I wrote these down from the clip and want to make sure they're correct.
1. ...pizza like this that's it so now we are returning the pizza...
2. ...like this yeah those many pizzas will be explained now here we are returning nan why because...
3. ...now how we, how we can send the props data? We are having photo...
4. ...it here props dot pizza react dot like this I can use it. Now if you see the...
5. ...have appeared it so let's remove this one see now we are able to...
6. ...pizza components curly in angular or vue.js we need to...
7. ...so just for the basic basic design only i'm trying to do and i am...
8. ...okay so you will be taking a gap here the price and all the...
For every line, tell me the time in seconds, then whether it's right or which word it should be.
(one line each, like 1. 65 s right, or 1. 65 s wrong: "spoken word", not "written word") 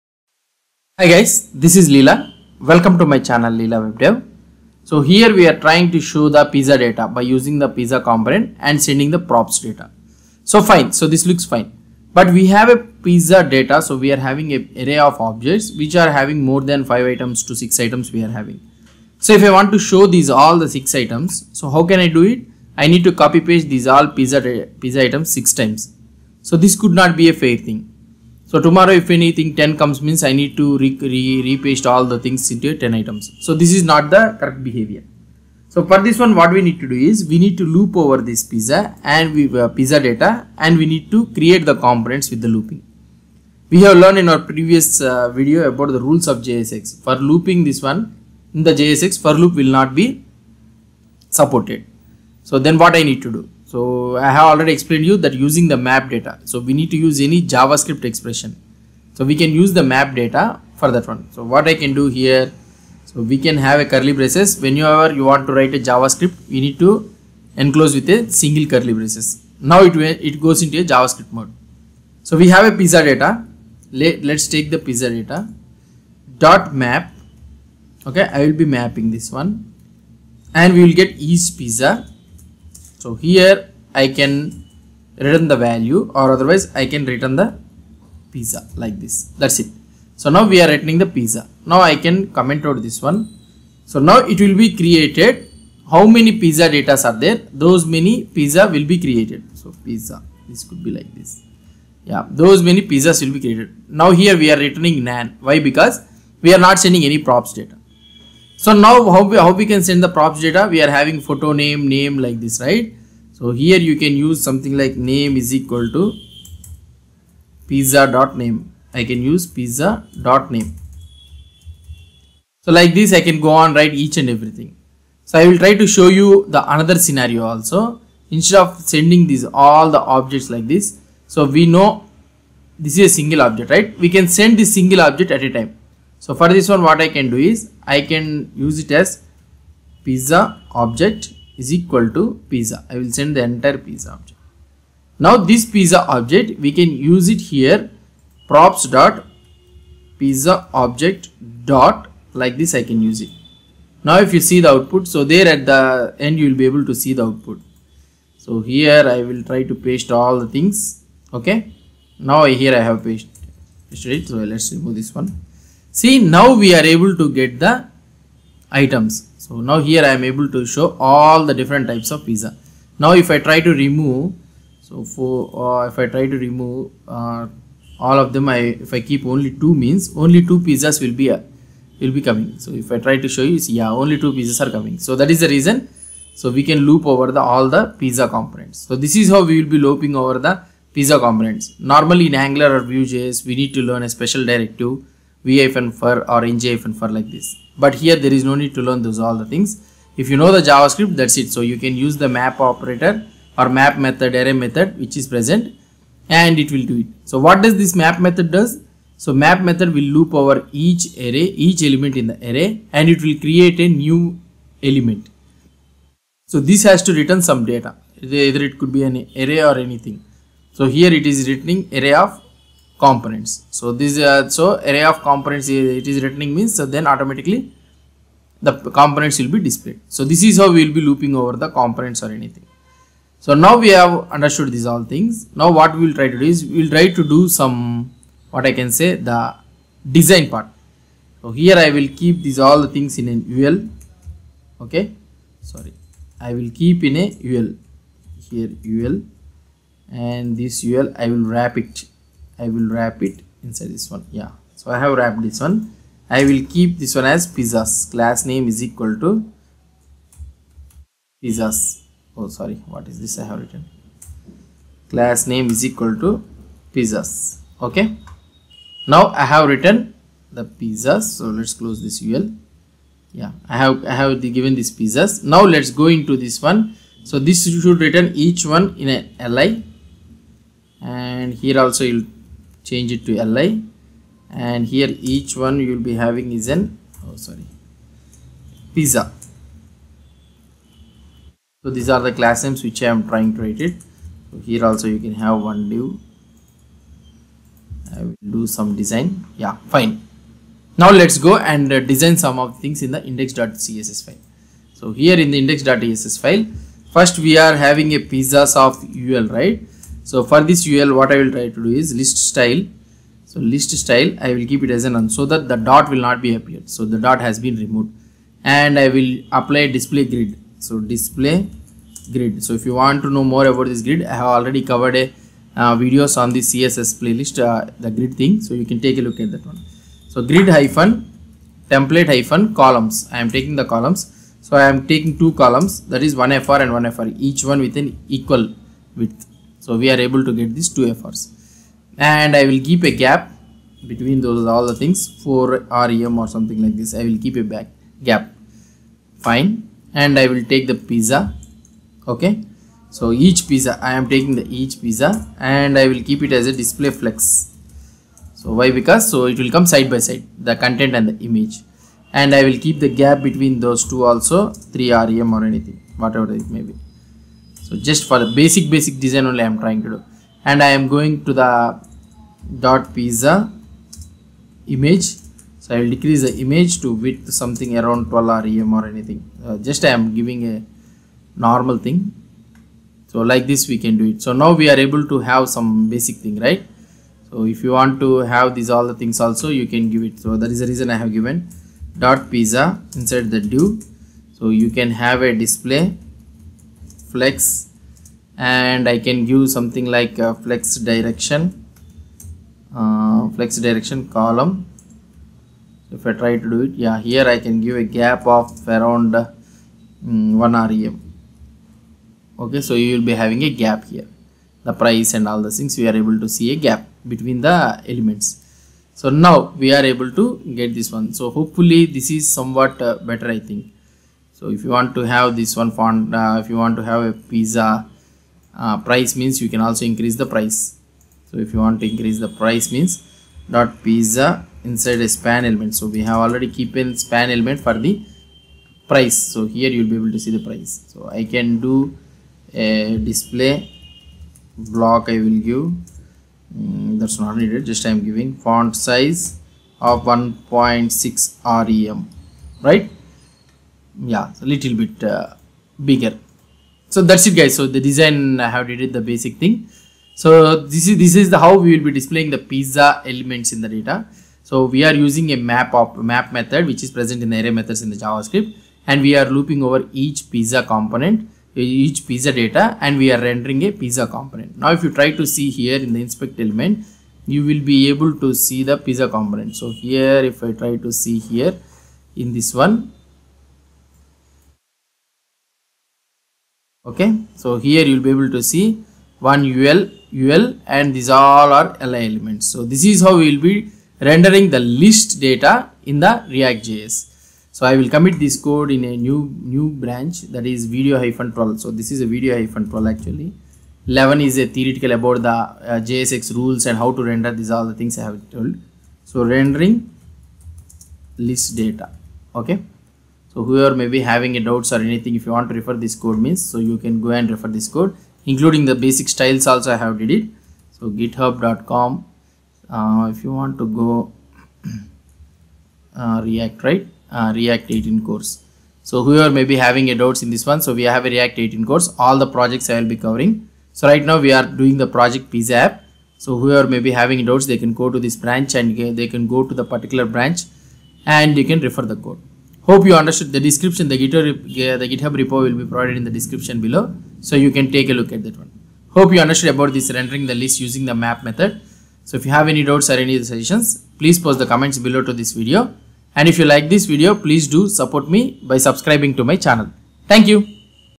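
1. 88 s right
2. 100 s wrong: "created", not "explained"
3. 108 s right
4. 147 s wrong: "object", not "react"
5. 162 s wrong: "pasted", not "appeared"
6. 190 s wrong: "normally", not "curly"
7. 367 s right
8. 412 s wrong: "having", not "taking".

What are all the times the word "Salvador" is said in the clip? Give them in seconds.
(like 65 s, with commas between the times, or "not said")
not said.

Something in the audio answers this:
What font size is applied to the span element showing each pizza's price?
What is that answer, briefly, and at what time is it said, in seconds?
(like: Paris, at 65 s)
1.6 rem, at 450 s.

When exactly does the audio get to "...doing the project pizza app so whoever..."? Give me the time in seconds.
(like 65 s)
534 s.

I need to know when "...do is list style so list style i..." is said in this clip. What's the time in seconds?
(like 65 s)
311 s.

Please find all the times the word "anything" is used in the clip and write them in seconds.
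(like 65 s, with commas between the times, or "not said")
29 s, 219 s, 232 s, 365 s, 379 s, 515 s.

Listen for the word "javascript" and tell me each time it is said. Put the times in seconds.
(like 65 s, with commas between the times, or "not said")
57 s, 65 s, 70 s, 200 s, 468 s.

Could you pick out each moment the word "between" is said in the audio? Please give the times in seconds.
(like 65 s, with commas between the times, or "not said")
344 s, 363 s, 417 s.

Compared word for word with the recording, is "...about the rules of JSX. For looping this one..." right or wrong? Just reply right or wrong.
right.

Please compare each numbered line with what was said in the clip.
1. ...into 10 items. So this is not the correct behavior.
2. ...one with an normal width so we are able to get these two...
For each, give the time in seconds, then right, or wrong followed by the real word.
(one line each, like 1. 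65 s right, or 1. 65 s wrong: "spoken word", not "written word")
1. 32 s right
2. 337 s wrong: "equal", not "normal".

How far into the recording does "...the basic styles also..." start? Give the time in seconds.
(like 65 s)
518 s.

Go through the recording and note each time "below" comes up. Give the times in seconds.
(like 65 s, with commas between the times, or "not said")
546 s, 554 s.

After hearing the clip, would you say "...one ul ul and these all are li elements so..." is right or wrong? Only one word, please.
right.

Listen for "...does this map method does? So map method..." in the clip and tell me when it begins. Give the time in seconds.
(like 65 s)
207 s.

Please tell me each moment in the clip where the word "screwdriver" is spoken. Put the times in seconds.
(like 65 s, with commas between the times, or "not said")
not said.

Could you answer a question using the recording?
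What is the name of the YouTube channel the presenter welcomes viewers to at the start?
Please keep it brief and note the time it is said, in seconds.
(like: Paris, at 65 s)
Leela WebDev, at 3 s.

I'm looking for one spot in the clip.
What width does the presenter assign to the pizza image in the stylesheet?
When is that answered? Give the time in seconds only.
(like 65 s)
378 s.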